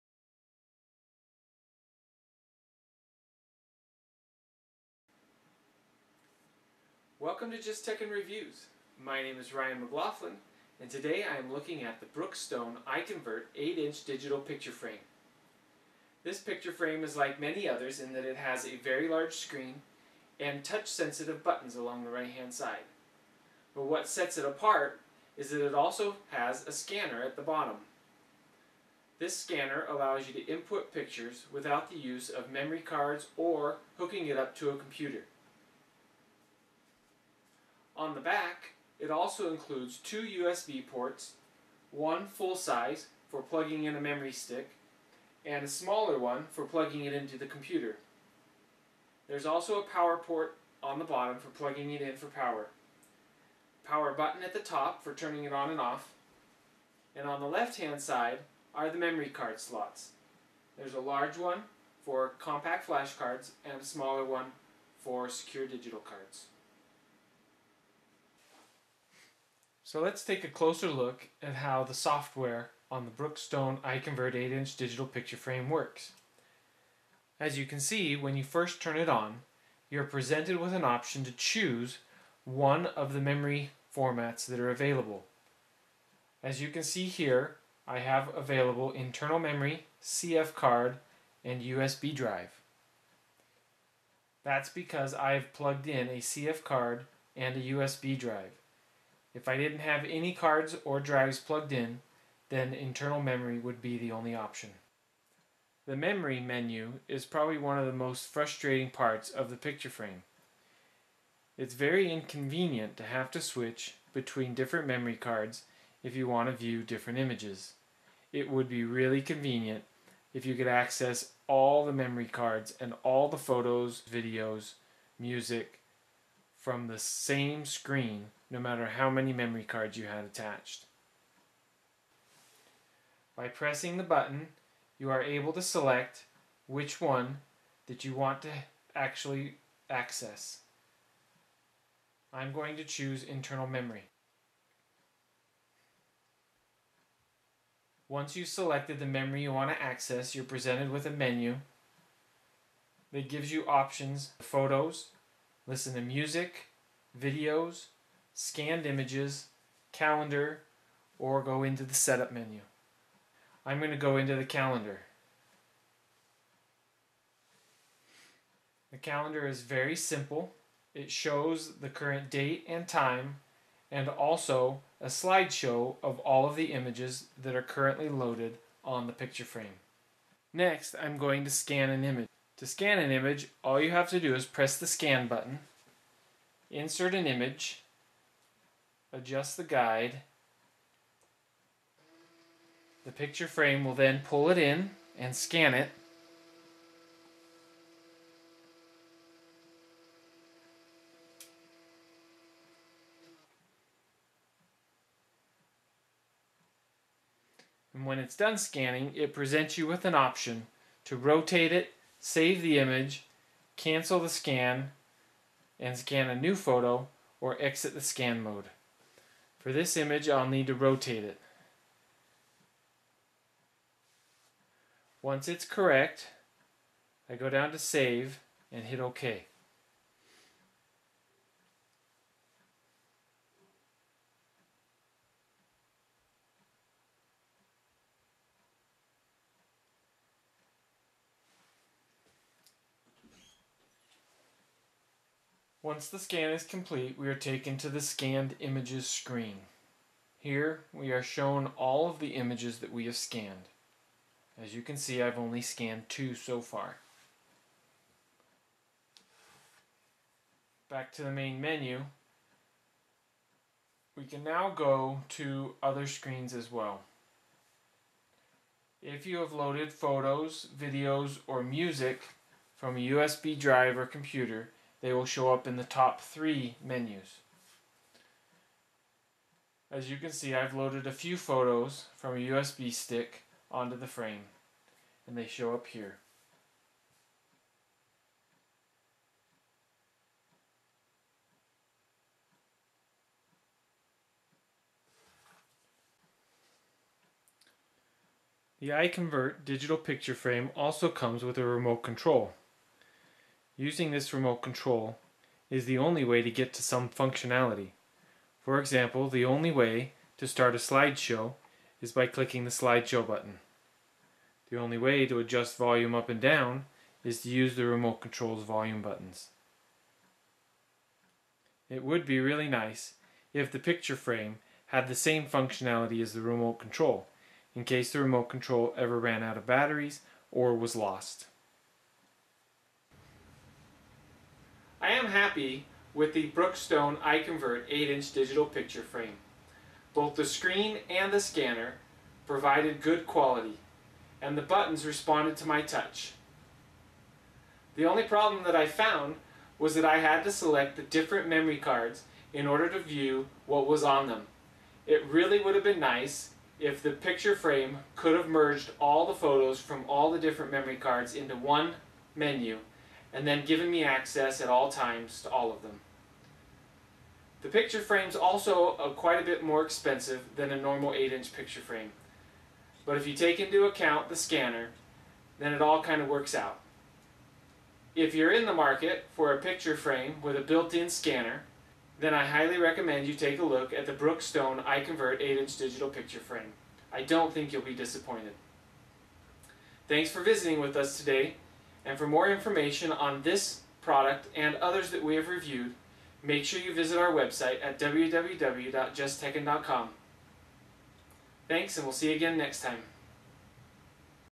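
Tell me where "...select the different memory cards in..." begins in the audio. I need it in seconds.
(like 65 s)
350 s.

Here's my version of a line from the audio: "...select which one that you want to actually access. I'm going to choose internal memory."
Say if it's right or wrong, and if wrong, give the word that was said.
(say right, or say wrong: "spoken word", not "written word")
right.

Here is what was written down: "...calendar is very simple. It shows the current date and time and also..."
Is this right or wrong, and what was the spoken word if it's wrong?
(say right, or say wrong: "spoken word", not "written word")
right.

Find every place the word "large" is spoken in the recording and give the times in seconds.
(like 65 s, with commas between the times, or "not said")
19 s, 60 s.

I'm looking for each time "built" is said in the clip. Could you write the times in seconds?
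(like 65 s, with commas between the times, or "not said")
380 s.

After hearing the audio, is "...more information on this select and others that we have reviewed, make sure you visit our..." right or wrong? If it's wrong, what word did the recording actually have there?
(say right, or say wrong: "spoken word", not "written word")
wrong: "product", not "select".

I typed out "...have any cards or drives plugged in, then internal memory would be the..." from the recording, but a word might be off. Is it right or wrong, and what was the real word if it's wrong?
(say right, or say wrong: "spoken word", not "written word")
right.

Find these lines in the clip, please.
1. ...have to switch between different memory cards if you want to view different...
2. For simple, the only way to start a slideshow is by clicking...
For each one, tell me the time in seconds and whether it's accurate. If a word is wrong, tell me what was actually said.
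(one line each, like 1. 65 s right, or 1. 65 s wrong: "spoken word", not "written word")
1. 113 s right
2. 308 s wrong: "example", not "simple".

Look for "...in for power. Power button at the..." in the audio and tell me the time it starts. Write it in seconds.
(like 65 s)
52 s.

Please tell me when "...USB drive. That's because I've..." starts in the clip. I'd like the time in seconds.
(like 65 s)
91 s.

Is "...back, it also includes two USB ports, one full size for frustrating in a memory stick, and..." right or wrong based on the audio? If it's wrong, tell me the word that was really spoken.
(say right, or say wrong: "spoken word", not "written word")
wrong: "plugging", not "frustrating".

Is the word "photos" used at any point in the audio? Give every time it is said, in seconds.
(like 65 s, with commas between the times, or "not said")
123 s, 154 s, 216 s, 269 s, 281 s, 359 s.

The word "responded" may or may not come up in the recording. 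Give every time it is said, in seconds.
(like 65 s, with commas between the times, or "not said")
345 s.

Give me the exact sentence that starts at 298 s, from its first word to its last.
The iConvert digital picture frame also comes with a remote control.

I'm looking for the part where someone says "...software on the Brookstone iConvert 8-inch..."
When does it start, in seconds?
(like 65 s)
71 s.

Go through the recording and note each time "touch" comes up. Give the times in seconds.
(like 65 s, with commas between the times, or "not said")
20 s, 345 s.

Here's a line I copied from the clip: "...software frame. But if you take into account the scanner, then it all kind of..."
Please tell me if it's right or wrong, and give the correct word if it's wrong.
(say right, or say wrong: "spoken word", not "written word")
wrong: "picture", not "software".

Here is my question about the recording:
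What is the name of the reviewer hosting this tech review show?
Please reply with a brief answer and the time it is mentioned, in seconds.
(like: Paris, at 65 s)
Ryan McLaughlin, at 9 s.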